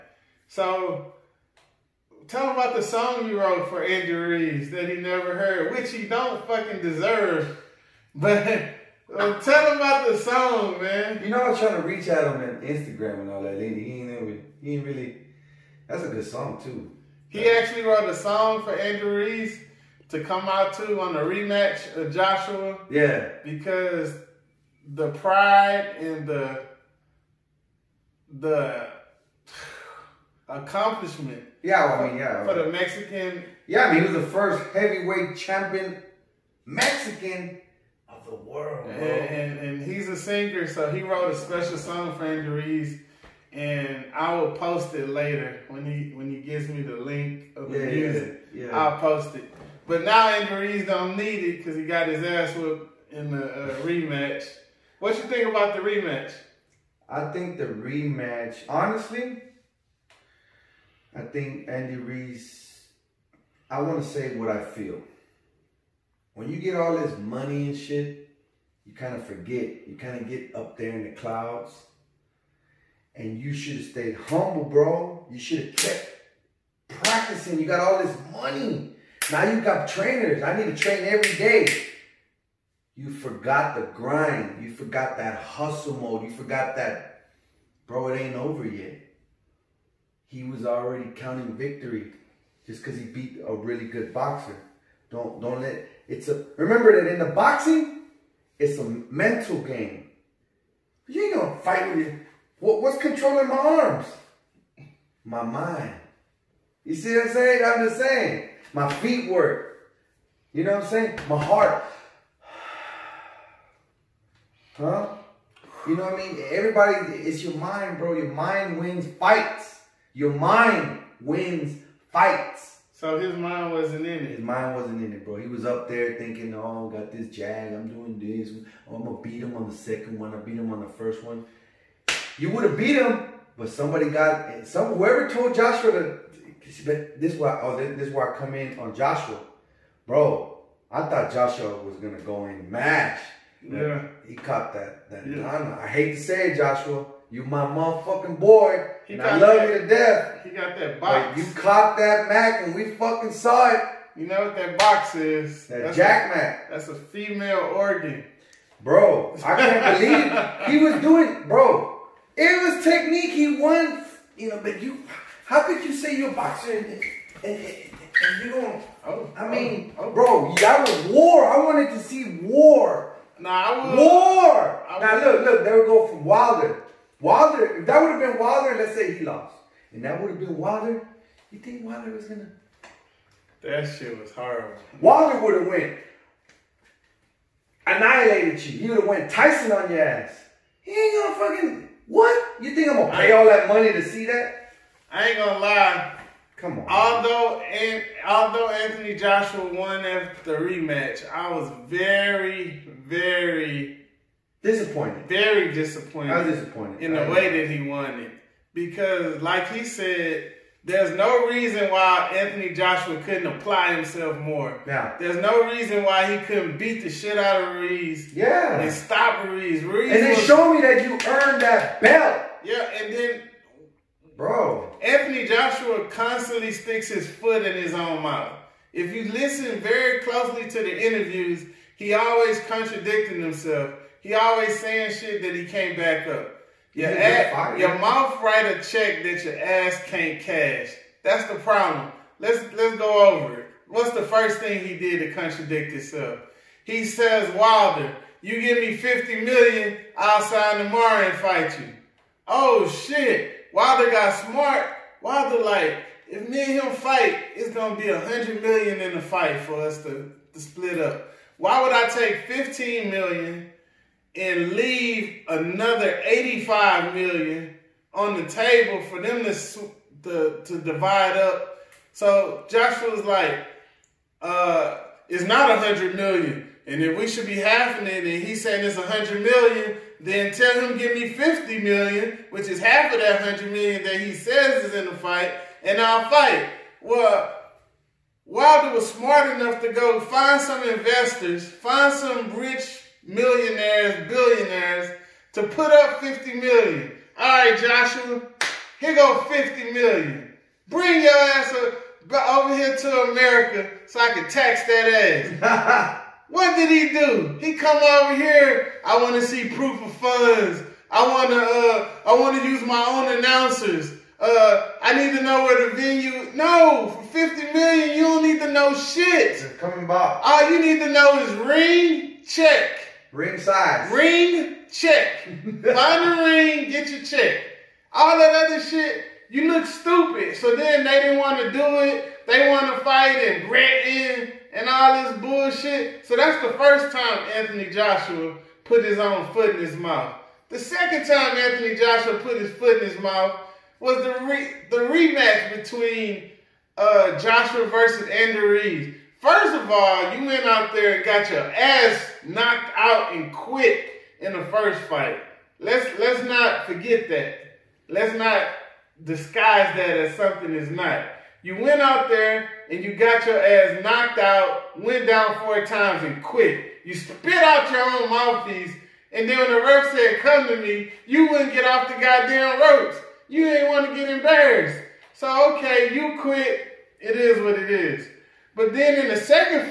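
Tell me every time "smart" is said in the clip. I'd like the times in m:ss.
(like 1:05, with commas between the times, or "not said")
4:14, 4:49.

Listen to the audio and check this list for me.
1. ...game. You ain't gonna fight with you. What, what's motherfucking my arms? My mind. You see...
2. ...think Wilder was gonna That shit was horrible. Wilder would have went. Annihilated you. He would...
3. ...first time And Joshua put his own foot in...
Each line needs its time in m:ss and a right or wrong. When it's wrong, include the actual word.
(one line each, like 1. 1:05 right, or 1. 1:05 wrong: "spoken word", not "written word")
1. 1:39 wrong: "controlling", not "motherfucking"
2. 3:01 right
3. 5:36 wrong: "Anthony", not "And".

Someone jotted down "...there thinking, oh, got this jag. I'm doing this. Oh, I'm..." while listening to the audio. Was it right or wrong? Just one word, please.
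right.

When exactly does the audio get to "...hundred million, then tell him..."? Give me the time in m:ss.
4:39.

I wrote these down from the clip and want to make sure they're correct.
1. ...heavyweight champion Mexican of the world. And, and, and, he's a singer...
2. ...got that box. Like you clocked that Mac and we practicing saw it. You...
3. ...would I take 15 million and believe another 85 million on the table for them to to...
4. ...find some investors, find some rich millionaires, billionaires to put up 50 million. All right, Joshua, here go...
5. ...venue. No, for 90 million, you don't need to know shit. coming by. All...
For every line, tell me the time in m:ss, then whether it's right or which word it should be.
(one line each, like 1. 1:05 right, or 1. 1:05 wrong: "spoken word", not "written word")
1. 0:34 right
2. 2:30 wrong: "fucking", not "practicing"
3. 4:21 wrong: "leave", not "believe"
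4. 4:50 right
5. 5:15 wrong: "50", not "90".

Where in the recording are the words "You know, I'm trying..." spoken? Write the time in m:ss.
0:11.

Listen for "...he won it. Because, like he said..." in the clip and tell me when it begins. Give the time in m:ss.
3:27.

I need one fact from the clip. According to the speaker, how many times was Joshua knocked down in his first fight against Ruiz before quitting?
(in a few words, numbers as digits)
4.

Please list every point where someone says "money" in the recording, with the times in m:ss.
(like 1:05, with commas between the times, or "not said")
1:07, 1:18, 3:13.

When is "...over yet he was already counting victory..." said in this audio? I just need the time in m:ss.
1:28.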